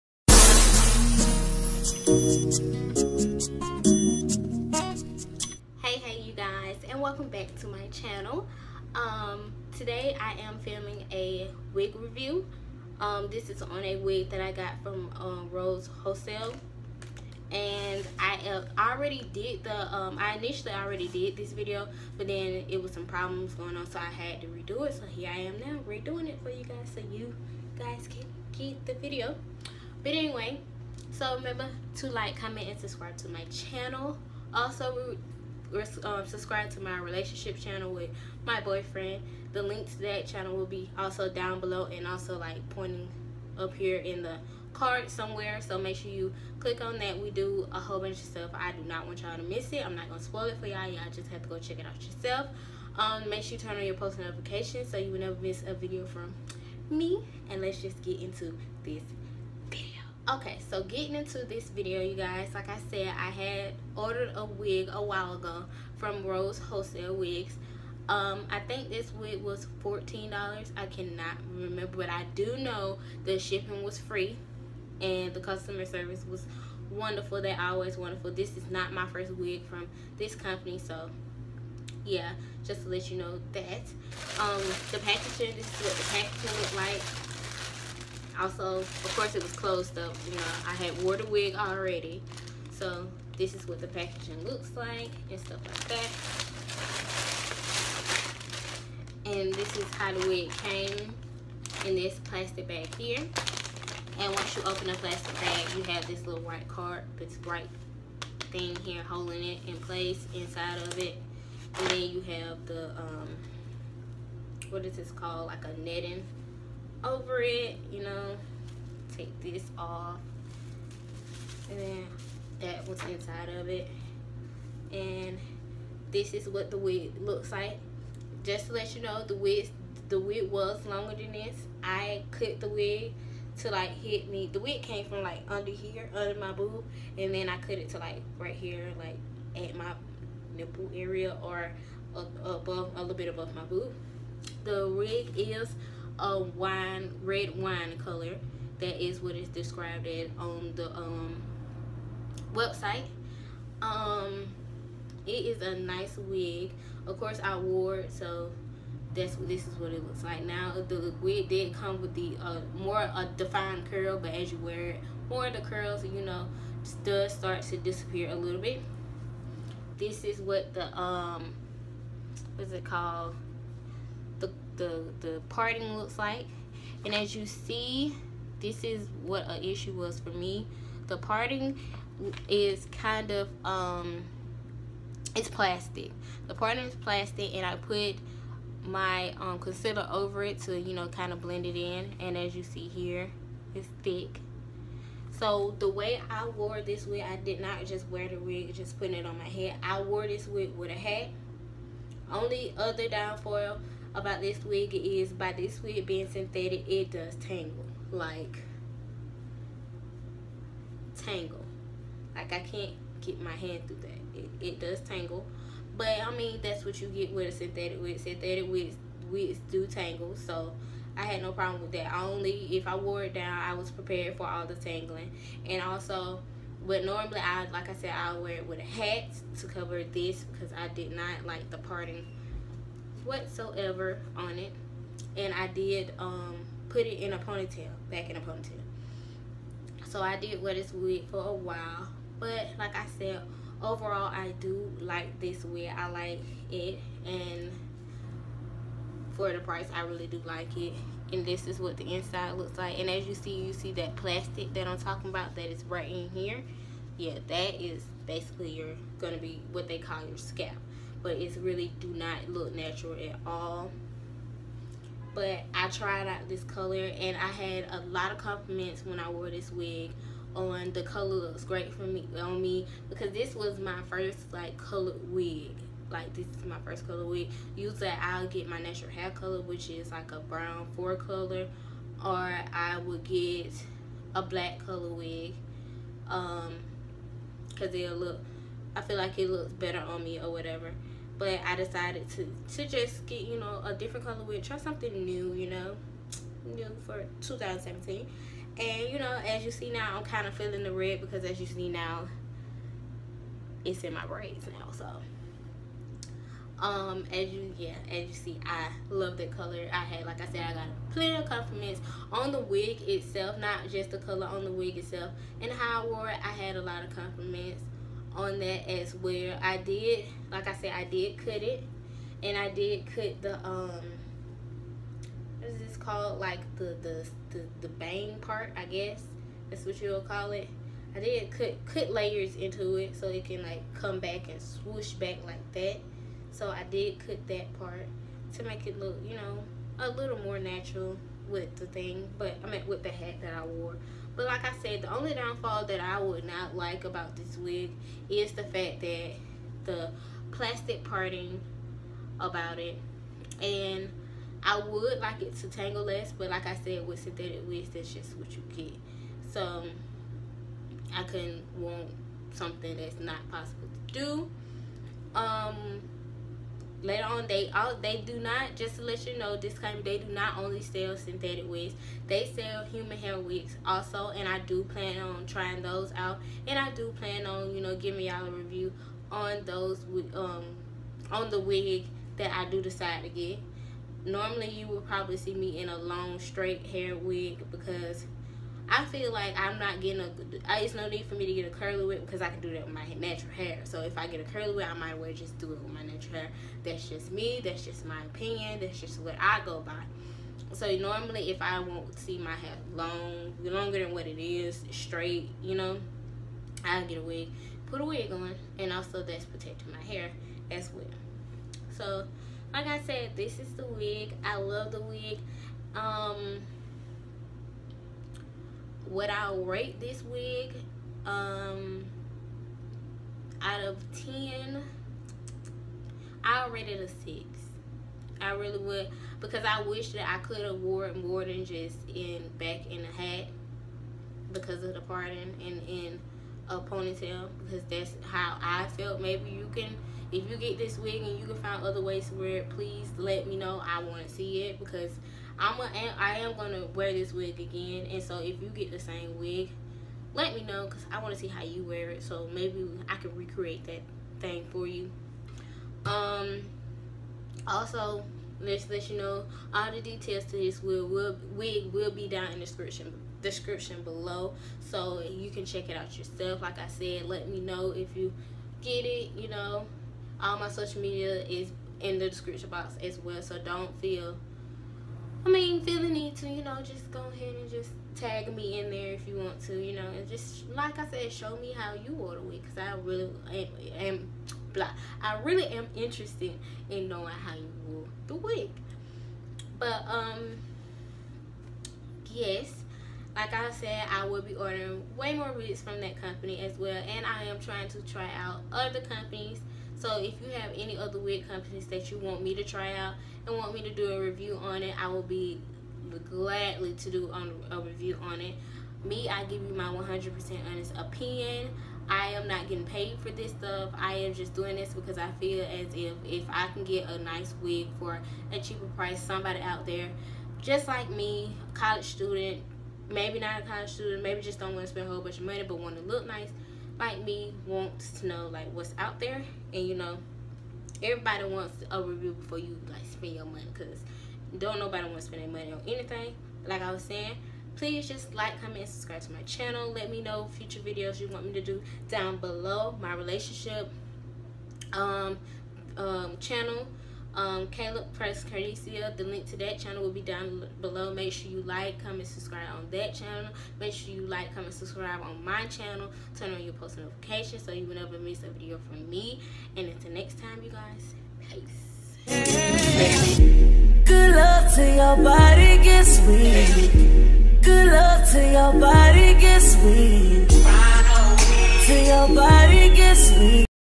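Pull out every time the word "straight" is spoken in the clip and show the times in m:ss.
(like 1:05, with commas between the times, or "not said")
6:26, 6:44.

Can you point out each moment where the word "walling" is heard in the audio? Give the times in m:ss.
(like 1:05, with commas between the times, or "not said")
not said.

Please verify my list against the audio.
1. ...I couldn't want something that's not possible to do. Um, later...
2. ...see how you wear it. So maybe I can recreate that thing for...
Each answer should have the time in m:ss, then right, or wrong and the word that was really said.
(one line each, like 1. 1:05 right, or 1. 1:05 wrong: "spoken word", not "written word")
1. 6:01 right
2. 7:31 right.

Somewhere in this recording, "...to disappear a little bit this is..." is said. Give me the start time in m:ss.
2:47.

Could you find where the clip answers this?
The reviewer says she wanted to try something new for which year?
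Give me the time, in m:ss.
4:57.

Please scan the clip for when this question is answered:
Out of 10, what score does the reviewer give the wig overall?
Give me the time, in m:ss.
7:07.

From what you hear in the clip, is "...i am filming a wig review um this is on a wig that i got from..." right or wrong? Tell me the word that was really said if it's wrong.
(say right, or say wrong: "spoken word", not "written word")
right.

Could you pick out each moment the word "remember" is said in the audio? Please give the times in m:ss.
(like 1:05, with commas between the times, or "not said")
0:31, 1:11.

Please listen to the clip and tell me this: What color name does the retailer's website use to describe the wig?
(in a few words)
wine red.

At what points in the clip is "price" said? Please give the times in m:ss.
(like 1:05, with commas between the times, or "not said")
4:09, 8:38.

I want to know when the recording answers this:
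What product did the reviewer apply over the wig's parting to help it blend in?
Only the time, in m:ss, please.
3:09.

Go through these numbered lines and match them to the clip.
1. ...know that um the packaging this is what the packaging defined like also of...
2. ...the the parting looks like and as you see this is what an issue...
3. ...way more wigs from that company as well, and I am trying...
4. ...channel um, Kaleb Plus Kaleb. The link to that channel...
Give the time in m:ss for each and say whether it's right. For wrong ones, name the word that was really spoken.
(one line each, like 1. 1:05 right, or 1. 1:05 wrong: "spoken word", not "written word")
1. 1:23 wrong: "looked", not "defined"
2. 2:54 right
3. 8:15 right
4. 9:06 wrong: "Carnica", not "Kaleb".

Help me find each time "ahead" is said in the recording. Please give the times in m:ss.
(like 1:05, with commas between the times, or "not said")
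7:57.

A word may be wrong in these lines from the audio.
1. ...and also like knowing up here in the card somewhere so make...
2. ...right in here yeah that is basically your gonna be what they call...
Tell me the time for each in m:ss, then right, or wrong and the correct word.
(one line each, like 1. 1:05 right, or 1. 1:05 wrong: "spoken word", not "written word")
1. 0:41 wrong: "pointing", not "knowing"
2. 4:15 right.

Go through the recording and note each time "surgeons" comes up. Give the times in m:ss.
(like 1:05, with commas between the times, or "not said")
not said.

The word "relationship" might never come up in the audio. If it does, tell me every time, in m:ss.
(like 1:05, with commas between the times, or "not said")
0:36, 9:03.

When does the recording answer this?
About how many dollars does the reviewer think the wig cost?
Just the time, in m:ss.
1:09.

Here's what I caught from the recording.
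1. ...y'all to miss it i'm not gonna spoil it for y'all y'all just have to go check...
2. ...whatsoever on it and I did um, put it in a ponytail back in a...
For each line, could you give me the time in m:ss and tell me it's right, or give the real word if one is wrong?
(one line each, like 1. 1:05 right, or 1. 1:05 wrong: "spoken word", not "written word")
1. 0:49 right
2. 3:53 right.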